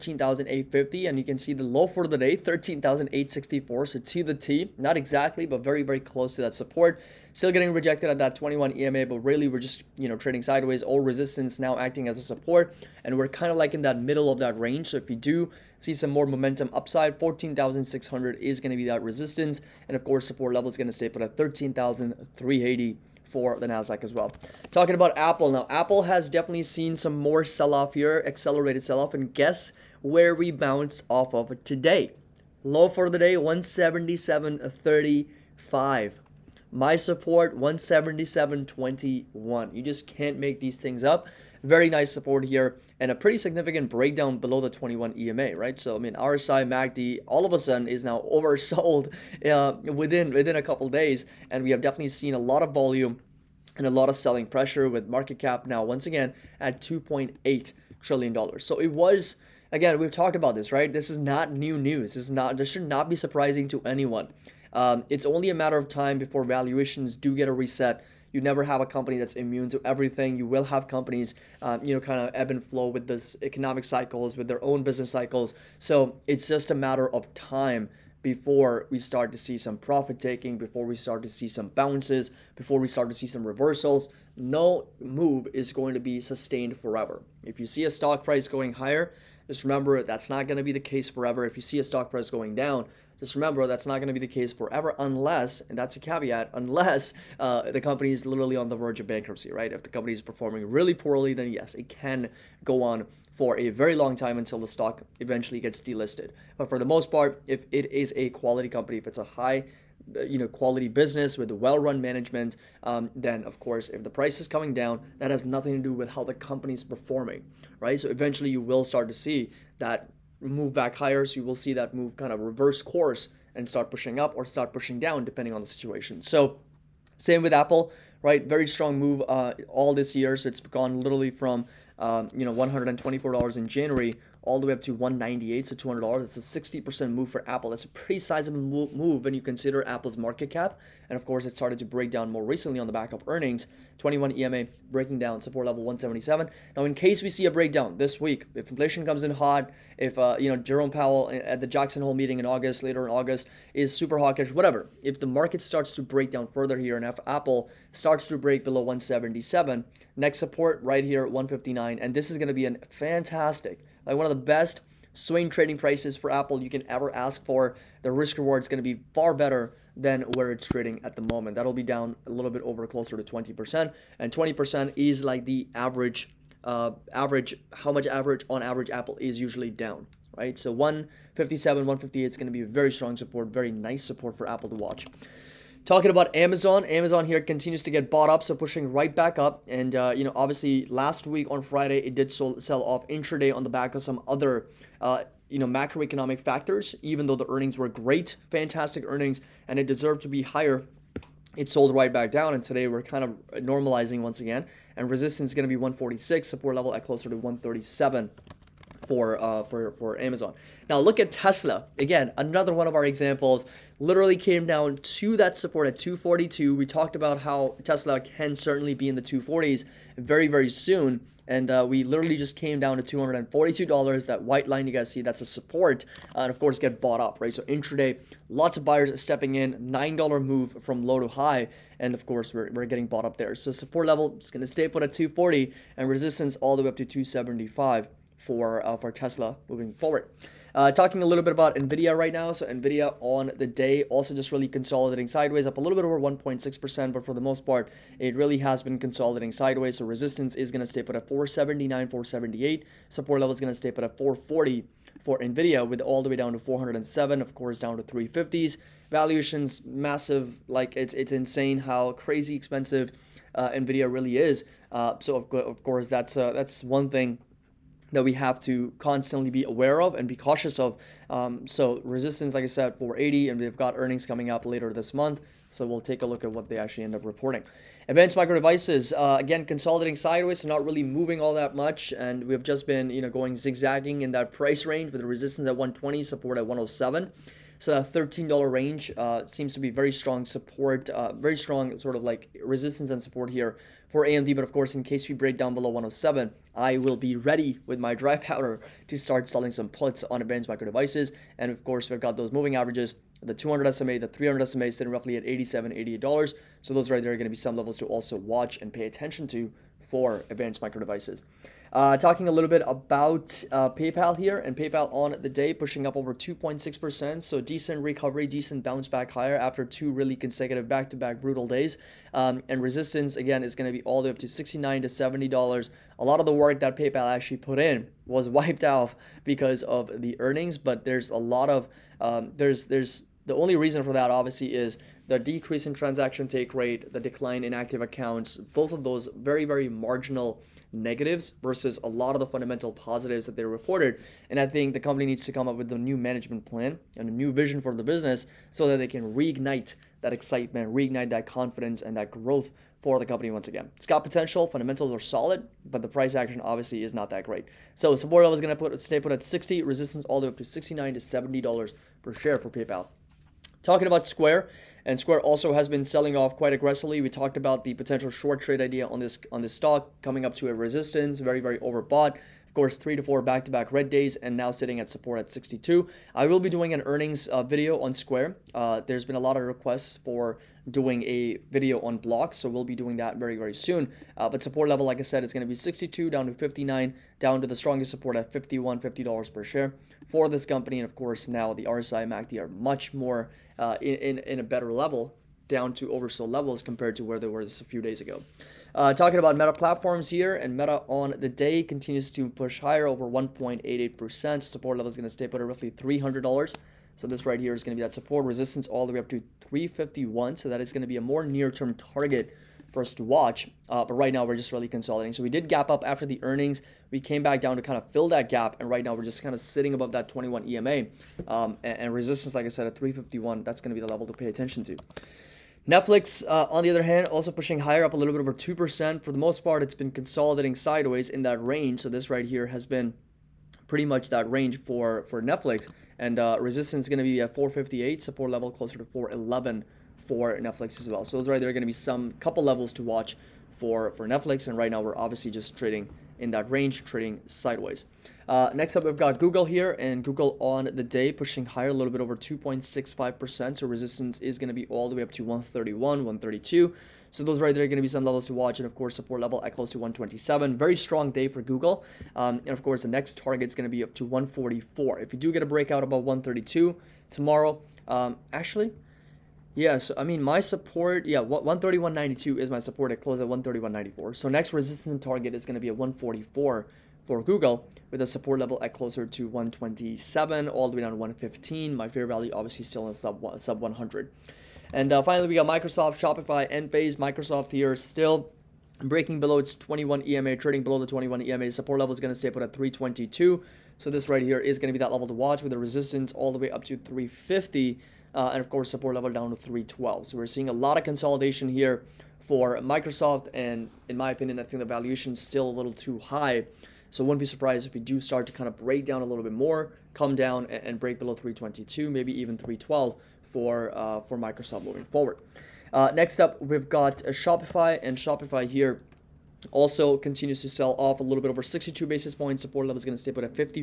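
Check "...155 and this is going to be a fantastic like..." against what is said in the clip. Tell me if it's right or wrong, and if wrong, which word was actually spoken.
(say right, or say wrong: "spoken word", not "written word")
wrong: "159", not "155".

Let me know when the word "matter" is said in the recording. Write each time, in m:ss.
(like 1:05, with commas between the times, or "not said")
1:05, 1:16.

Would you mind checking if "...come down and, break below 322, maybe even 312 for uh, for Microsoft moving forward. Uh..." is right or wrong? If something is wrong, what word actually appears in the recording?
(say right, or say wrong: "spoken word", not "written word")
right.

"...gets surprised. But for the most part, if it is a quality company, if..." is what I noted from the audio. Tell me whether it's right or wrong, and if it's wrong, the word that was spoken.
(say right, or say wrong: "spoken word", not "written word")
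wrong: "delisted", not "surprised".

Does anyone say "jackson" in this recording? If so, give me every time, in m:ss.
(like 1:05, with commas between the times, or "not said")
2:31.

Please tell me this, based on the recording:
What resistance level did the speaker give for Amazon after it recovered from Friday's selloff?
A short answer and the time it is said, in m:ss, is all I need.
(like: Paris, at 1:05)
146, at 3:25.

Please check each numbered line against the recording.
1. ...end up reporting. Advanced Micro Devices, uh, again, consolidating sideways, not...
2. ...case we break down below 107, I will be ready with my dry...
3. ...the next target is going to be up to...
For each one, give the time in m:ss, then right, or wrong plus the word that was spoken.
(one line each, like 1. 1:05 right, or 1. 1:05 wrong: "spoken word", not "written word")
1. 4:37 right
2. 4:55 right
3. 7:43 right.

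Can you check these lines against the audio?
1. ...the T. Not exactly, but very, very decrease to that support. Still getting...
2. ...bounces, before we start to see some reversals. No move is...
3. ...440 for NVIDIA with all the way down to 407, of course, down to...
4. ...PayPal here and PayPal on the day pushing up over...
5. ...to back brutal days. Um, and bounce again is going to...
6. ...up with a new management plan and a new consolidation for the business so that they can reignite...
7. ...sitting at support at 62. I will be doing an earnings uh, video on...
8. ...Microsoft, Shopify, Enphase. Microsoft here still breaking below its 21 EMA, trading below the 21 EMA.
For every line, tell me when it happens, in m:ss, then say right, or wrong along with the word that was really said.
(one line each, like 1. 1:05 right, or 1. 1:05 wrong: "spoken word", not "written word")
1. 0:04 wrong: "close", not "decrease"
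2. 1:21 right
3. 4:14 right
4. 5:13 right
5. 5:21 wrong: "resistance", not "bounce"
6. 5:45 wrong: "vision", not "consolidation"
7. 6:14 right
8. 8:05 right.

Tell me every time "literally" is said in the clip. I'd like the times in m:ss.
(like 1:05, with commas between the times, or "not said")
1:38, 2:11, 3:34, 3:42.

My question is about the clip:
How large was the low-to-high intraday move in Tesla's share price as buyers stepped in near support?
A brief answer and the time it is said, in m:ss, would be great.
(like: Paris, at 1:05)
$9, at 3:49.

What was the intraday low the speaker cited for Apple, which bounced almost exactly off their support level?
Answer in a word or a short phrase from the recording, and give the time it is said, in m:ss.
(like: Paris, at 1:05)
177.35, at 0:33.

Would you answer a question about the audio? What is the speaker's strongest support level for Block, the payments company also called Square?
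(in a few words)
$50.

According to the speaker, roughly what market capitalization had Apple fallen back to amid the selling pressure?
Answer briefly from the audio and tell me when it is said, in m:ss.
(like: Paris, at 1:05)
2.8 trillion dollars, at 0:56.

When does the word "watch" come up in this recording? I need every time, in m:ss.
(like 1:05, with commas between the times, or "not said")
3:04, 5:08, 6:53, 7:23, 7:38, 8:15.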